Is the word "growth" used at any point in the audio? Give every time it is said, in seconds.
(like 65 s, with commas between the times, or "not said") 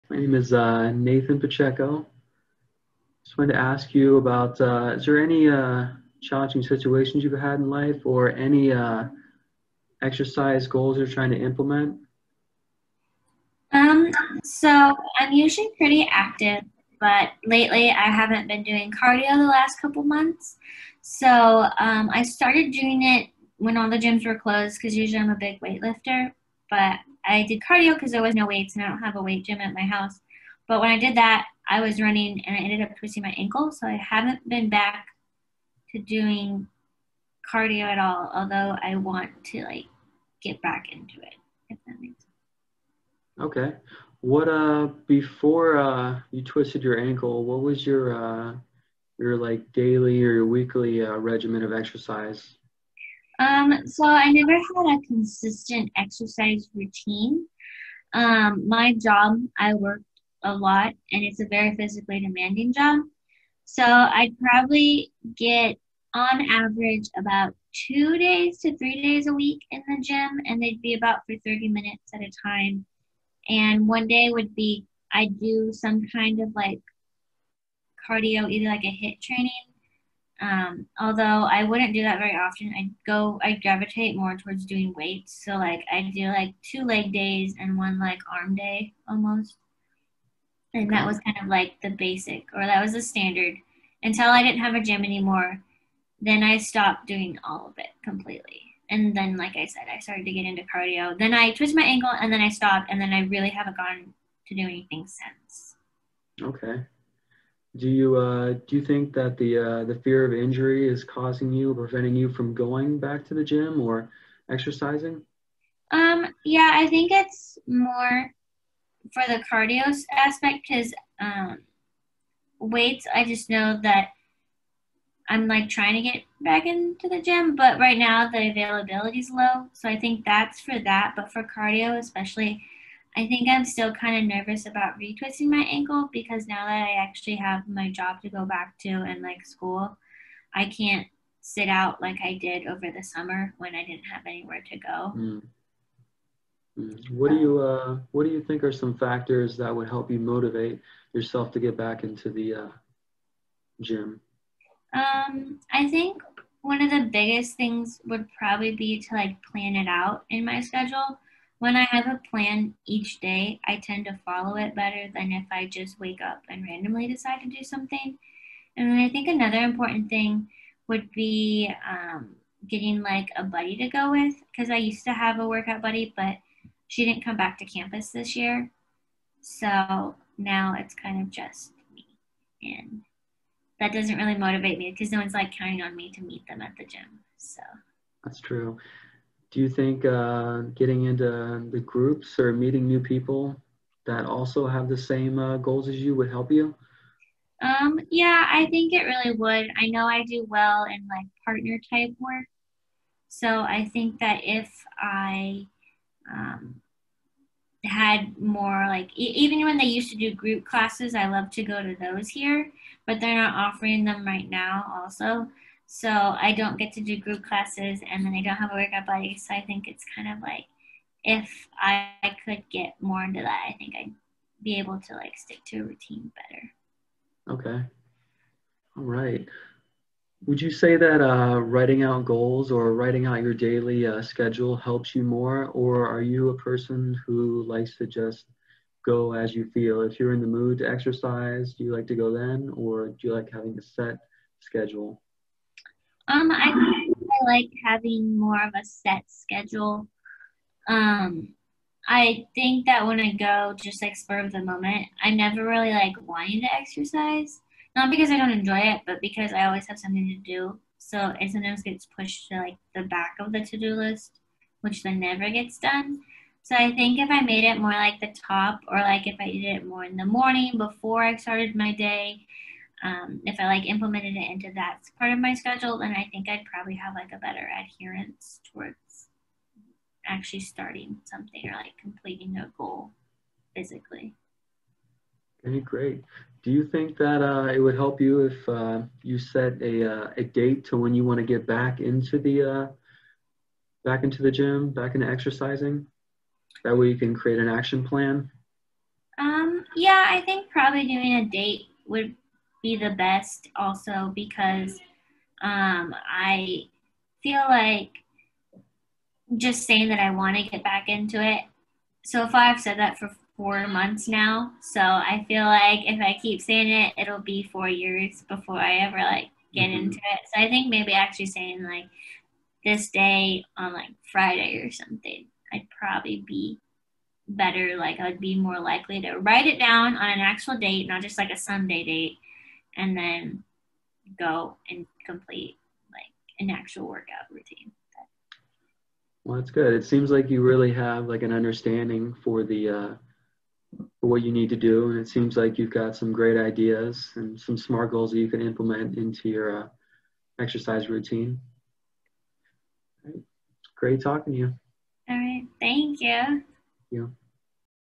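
not said.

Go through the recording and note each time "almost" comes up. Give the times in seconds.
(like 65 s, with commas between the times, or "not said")
89 s.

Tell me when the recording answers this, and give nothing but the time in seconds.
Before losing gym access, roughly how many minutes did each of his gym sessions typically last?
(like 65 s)
71 s.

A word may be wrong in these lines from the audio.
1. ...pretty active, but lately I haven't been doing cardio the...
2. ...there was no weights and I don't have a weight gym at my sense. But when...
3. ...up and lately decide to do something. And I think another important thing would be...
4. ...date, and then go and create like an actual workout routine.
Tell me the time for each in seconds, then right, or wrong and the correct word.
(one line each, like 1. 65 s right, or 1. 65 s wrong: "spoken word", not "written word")
1. 15 s right
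2. 28 s wrong: "house", not "sense"
3. 166 s wrong: "randomly", not "lately"
4. 332 s wrong: "complete", not "create".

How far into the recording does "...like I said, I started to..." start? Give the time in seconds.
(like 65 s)
99 s.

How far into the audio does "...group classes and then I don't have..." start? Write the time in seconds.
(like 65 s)
217 s.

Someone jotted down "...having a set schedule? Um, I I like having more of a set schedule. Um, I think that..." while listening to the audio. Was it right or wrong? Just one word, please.
right.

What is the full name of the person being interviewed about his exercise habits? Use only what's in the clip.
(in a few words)
Nathan Pacheco.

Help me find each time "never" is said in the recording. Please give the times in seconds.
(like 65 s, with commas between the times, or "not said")
54 s, 255 s, 265 s.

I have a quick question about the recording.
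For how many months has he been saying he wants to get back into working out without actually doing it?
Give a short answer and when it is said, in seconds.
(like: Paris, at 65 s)
4, at 313 s.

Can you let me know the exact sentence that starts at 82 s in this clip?
I go, I gravitate more towards doing weights.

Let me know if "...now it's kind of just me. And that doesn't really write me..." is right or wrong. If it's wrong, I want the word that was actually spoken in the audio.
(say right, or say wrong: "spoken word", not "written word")
wrong: "motivate", not "write".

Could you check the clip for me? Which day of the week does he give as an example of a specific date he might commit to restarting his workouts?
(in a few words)
Friday.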